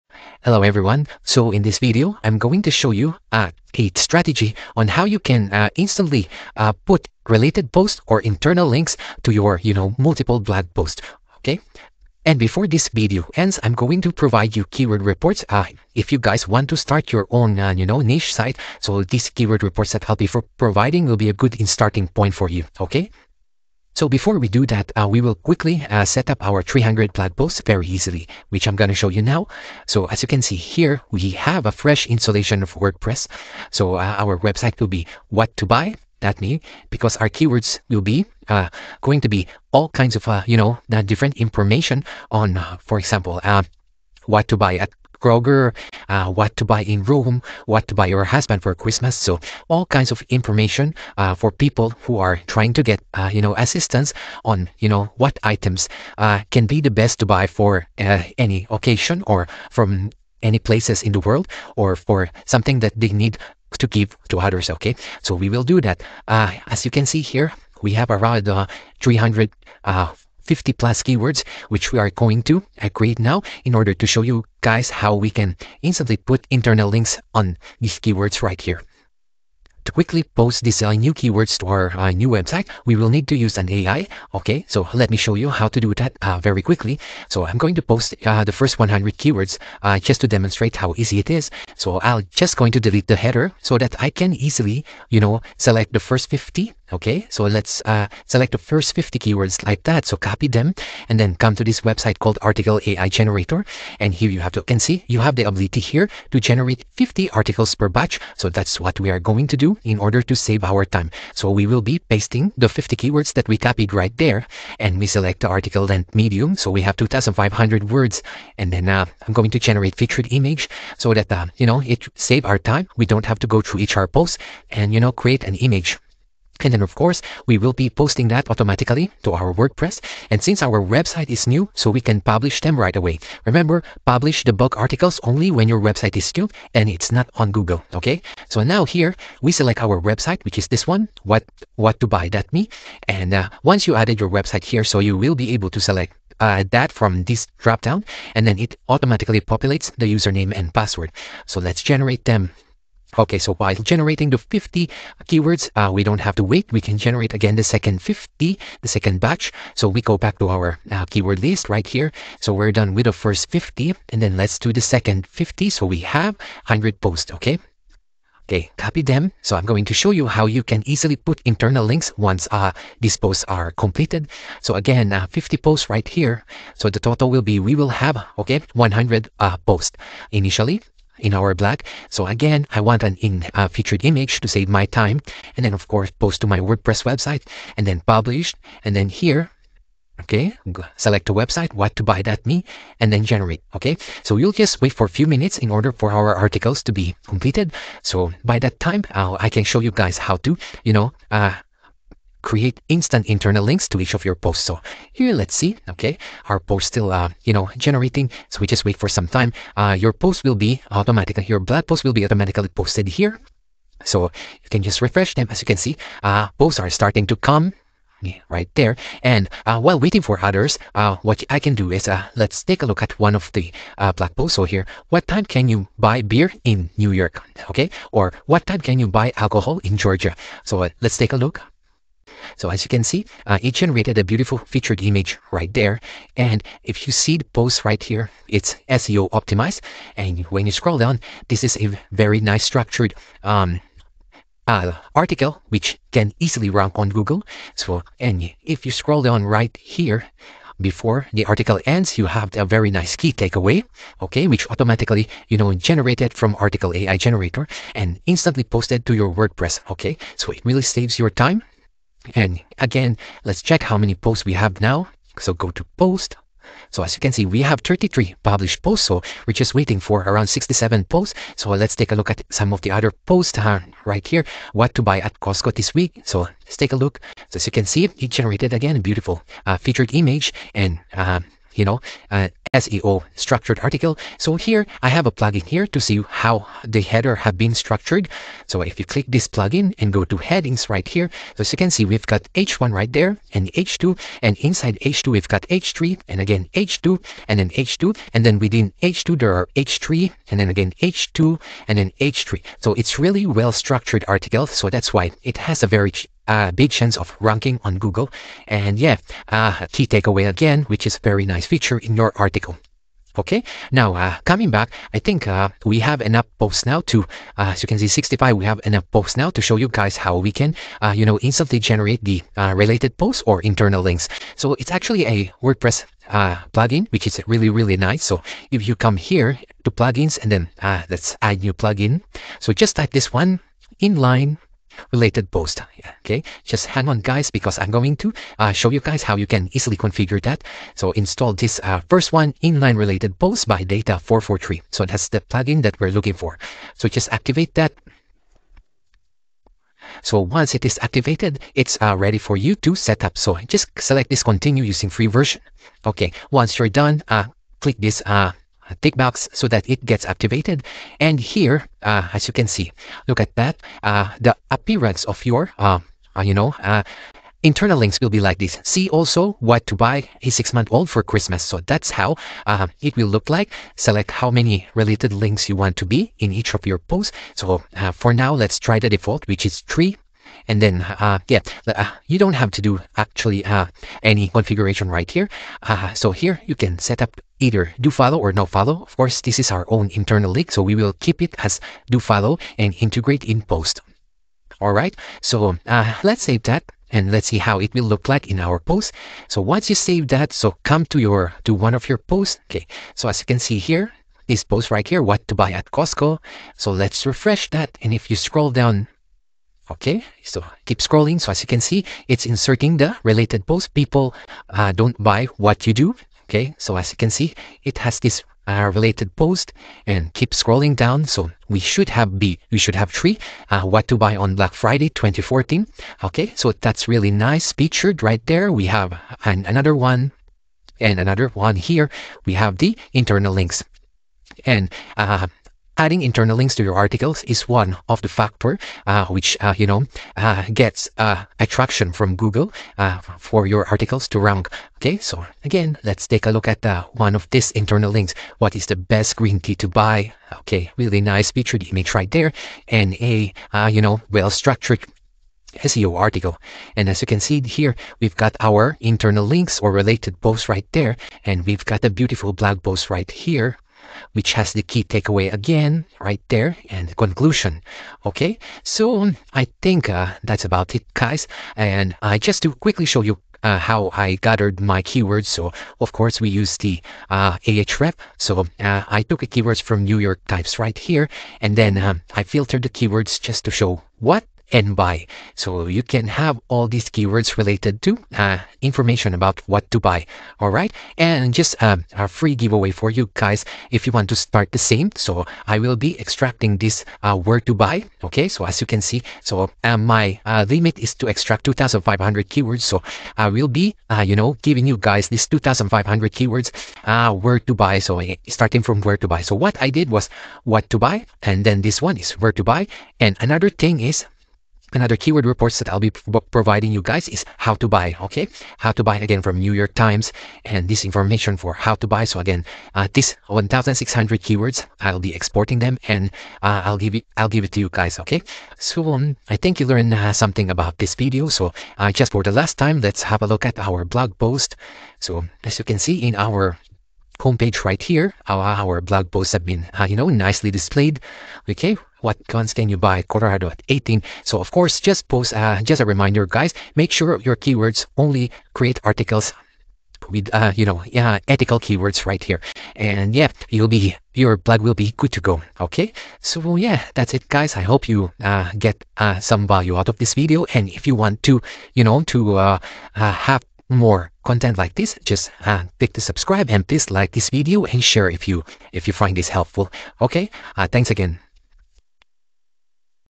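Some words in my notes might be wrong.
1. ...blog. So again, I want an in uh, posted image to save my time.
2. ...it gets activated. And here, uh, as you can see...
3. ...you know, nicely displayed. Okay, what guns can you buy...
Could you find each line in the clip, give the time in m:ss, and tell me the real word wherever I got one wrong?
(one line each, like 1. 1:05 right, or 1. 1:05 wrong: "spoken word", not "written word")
1. 3:01 wrong: "featured", not "posted"
2. 5:59 right
3. 9:00 right.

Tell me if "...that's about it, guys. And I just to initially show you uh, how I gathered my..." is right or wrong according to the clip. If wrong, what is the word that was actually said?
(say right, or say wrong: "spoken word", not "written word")
wrong: "quickly", not "initially".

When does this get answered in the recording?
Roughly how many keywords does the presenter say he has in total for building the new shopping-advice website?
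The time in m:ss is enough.
1:09.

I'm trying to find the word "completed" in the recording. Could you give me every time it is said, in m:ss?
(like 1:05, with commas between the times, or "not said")
2:53, 3:17.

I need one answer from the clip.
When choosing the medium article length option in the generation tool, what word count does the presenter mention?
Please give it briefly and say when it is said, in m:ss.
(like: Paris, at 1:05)
2,500 words, at 1:56.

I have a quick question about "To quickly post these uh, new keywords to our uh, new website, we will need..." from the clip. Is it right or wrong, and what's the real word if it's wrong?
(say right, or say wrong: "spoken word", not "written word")
right.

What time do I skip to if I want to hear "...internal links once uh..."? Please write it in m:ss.
2:51.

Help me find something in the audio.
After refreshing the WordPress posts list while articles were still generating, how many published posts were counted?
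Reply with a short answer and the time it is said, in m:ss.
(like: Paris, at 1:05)
33, at 4:27.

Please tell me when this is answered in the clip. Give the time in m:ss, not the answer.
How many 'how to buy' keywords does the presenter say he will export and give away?
8:43.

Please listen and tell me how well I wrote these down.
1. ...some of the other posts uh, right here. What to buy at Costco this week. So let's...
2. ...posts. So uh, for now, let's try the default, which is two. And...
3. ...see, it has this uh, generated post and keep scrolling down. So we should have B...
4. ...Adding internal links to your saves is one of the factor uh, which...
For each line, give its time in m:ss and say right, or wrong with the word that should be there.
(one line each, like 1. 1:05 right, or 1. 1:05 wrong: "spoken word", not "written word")
1. 4:32 right
2. 6:16 wrong: "three", not "two"
3. 6:57 wrong: "related", not "generated"
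4. 7:15 wrong: "articles", not "saves".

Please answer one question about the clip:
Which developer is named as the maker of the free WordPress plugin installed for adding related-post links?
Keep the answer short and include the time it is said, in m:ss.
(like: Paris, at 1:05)
Data 443, at 5:43.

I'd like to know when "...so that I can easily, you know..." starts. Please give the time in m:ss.
1:33.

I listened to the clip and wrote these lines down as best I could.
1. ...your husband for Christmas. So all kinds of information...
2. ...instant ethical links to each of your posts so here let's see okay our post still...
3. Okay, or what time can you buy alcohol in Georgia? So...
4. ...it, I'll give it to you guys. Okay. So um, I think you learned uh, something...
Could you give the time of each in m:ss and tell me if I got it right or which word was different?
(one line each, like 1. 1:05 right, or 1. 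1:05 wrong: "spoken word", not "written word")
1. 0:48 right
2. 3:22 wrong: "internal", not "ethical"
3. 3:47 right
4. 8:47 right.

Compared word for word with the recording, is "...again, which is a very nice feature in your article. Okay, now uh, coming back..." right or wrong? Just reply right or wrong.
right.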